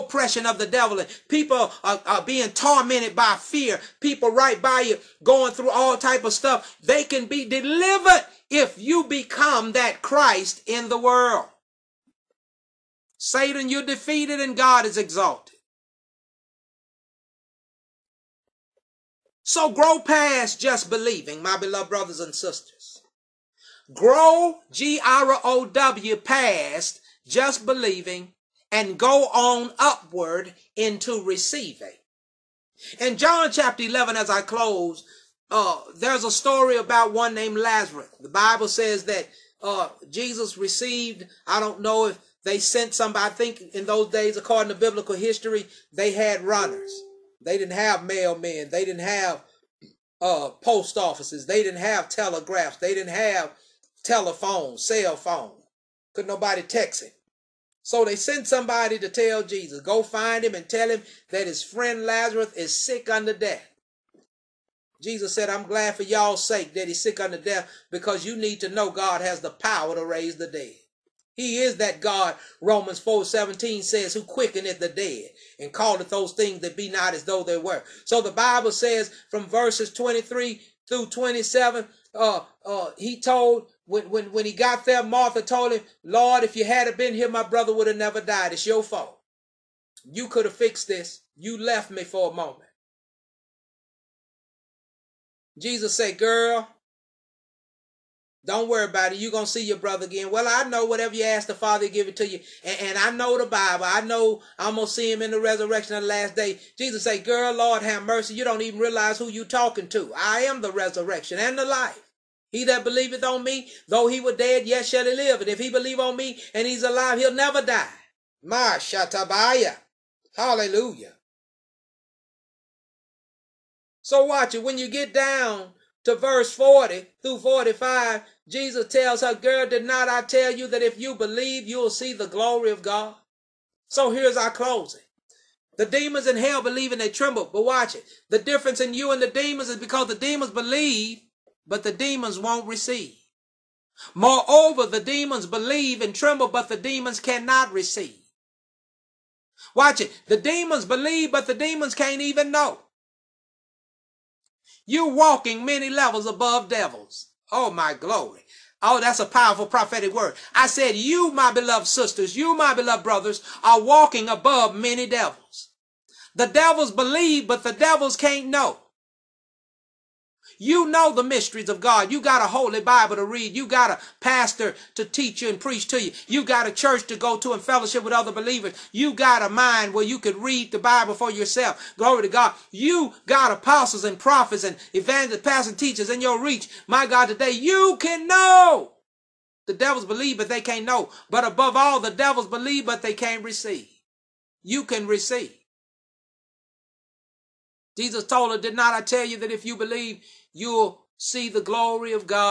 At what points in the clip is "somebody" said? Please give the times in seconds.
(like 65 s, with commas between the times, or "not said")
42 s, 58 s.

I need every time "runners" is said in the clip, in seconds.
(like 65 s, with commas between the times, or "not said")
46 s.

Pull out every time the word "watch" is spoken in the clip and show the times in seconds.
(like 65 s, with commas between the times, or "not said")
124 s, 137 s, 149 s.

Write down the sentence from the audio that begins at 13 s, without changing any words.
Satan, you're defeated and God is exalted.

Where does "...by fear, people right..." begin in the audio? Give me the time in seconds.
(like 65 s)
3 s.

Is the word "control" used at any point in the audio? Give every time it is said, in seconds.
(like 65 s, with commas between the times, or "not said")
not said.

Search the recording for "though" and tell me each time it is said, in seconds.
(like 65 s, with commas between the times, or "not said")
77 s, 113 s.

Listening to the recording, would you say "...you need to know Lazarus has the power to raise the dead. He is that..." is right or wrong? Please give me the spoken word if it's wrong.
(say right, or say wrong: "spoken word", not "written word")
wrong: "God", not "Lazarus".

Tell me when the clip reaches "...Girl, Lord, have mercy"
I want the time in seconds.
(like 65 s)
107 s.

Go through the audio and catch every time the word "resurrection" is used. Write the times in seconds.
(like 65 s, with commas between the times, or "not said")
105 s, 110 s.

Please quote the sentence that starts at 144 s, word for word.
Moreover, the demons believe and tremble, but the demons cannot receive.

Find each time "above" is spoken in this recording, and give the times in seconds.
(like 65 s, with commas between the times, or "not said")
156 s, 164 s, 191 s.